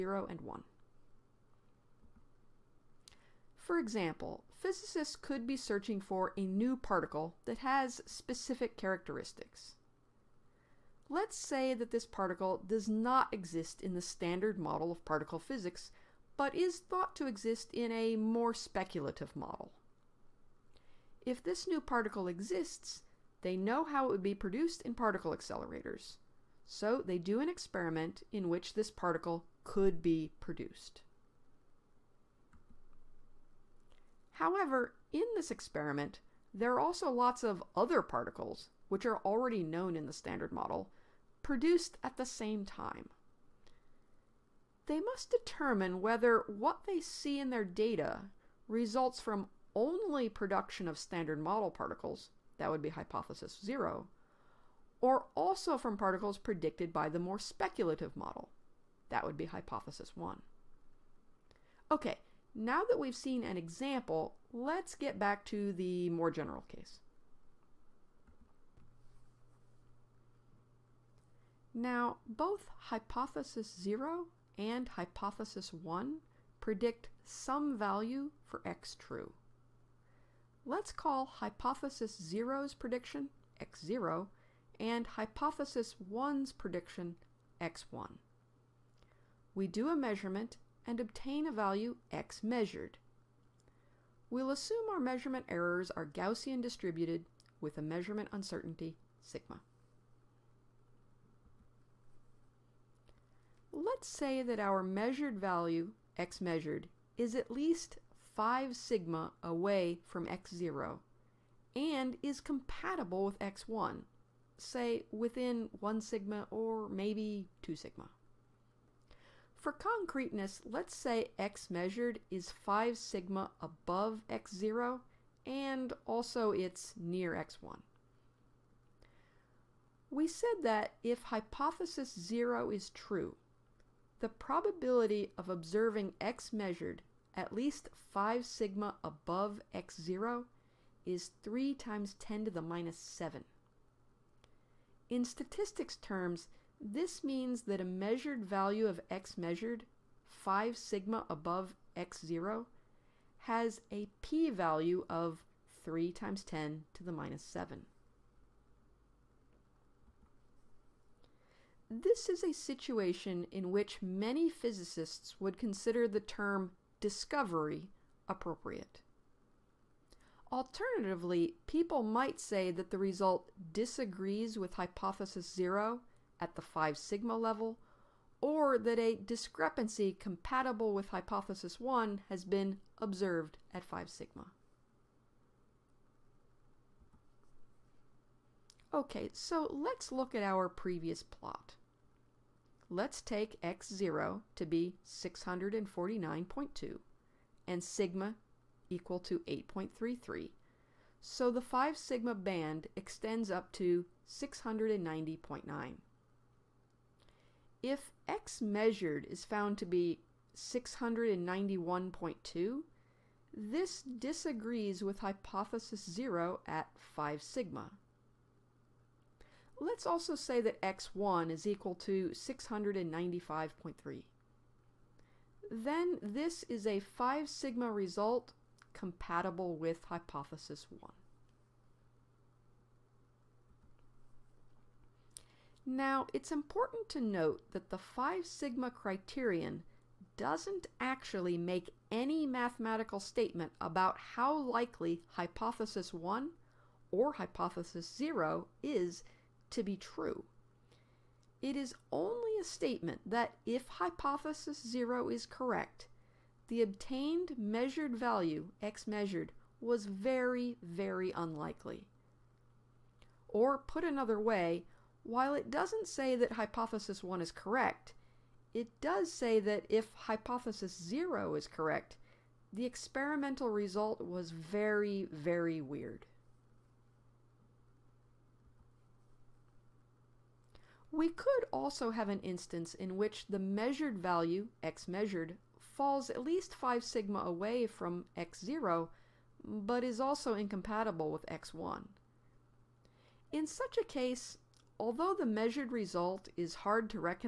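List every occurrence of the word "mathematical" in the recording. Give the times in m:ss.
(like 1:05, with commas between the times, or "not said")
4:02.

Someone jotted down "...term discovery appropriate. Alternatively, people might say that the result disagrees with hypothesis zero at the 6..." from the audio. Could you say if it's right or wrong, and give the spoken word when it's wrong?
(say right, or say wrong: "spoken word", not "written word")
wrong: "5", not "6".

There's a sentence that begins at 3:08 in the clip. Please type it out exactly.
Okay, so let's look at our previous plot.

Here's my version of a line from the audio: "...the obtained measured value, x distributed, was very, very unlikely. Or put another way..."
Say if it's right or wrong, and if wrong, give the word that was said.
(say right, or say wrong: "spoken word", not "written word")
wrong: "measured", not "distributed".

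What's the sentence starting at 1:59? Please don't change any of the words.
For concreteness, let's say x measured is 5 sigma above x0 and also it's near x1.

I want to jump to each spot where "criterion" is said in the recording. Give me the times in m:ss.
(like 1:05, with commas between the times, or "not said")
3:58.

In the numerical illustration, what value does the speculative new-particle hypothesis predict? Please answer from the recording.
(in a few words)
695.3.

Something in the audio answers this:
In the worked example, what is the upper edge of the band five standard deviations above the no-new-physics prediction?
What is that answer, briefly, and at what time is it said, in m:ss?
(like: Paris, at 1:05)
690.9, at 3:24.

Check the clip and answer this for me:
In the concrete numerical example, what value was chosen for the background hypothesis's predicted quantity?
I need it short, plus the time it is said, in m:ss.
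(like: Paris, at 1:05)
649.2, at 3:15.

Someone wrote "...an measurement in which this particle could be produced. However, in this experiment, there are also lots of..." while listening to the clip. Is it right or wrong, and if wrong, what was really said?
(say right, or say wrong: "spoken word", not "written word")
wrong: "experiment", not "measurement".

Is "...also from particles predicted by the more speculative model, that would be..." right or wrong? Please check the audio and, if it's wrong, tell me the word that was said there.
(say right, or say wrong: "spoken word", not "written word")
right.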